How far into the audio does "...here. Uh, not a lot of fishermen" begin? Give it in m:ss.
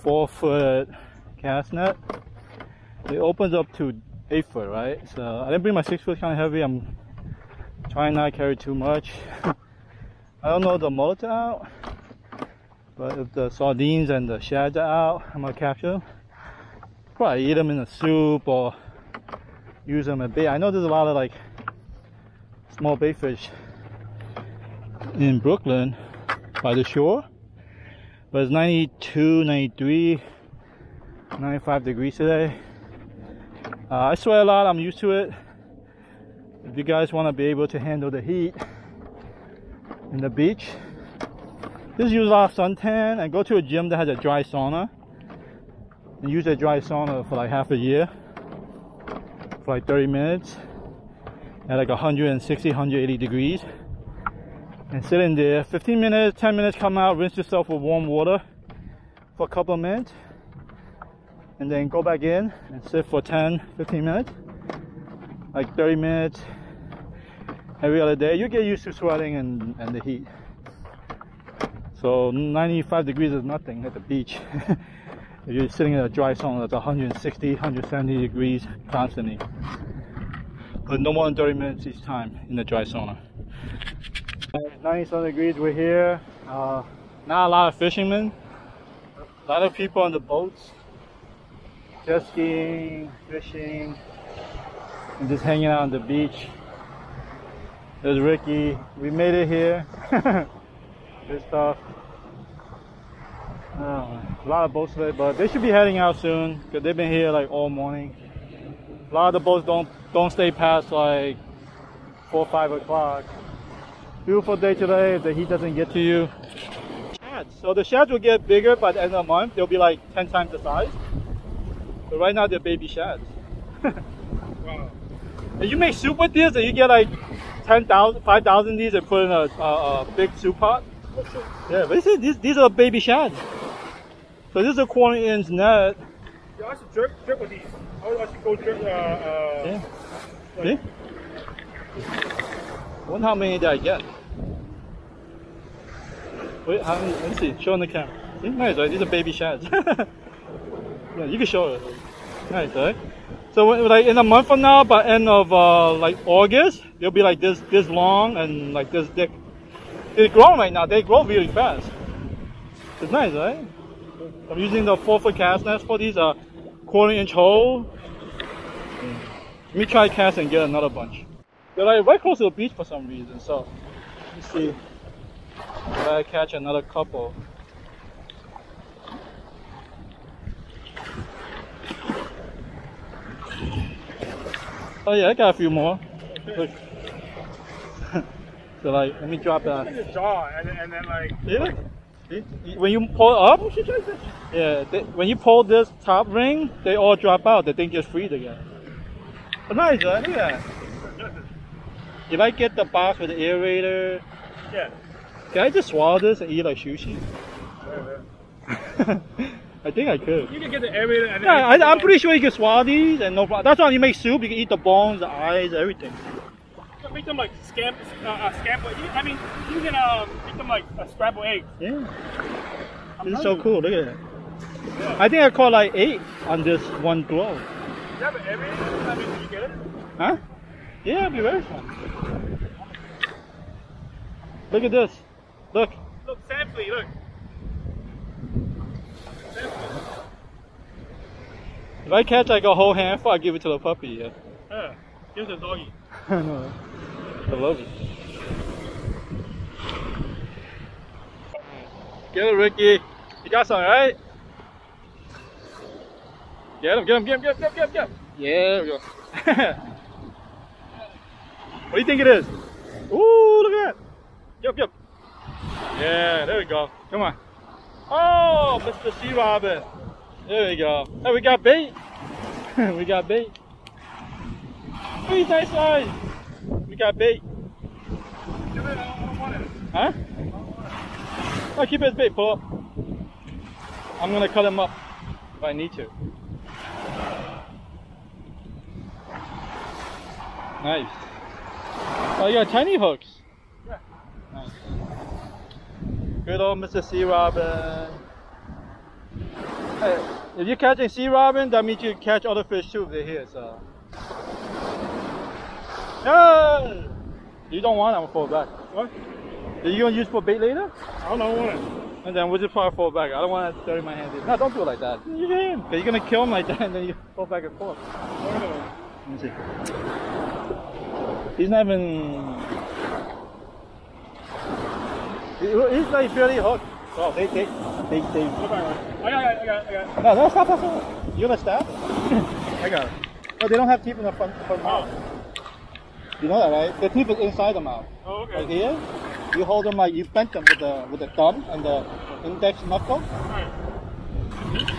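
1:25.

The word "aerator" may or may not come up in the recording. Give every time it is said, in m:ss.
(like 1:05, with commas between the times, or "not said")
3:23, 3:30.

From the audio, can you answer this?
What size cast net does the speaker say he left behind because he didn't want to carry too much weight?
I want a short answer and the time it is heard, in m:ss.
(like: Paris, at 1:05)
6 foot, at 0:05.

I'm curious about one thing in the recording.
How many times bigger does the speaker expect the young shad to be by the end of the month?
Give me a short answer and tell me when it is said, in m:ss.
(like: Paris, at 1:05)
10 times, at 2:00.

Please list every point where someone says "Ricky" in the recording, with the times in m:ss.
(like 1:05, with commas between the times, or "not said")
1:38, 4:12.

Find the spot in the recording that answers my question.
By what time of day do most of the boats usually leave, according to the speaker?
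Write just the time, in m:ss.
1:52.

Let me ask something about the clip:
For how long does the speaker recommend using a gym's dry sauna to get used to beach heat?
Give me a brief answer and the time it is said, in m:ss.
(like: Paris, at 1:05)
half a year, at 0:47.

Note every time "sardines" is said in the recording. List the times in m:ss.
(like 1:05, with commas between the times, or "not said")
0:13.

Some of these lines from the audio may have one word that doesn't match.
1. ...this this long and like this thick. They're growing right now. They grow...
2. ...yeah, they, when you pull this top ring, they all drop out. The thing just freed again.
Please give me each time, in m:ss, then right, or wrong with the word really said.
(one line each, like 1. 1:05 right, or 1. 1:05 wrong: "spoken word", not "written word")
1. 2:37 right
2. 3:14 right.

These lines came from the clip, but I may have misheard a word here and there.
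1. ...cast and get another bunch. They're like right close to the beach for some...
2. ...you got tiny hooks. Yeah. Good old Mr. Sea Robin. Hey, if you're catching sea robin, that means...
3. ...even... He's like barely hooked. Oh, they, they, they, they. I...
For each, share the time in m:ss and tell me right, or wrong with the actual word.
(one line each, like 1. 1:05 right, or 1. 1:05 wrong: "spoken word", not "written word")
1. 2:50 right
2. 4:52 right
3. 5:21 right.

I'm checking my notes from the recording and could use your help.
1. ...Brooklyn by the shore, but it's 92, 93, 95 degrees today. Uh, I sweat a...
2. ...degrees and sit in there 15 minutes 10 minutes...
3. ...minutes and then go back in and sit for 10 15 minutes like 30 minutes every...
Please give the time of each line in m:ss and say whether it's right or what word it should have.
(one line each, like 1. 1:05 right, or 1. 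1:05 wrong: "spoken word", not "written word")
1. 0:25 right
2. 0:53 right
3. 0:59 right.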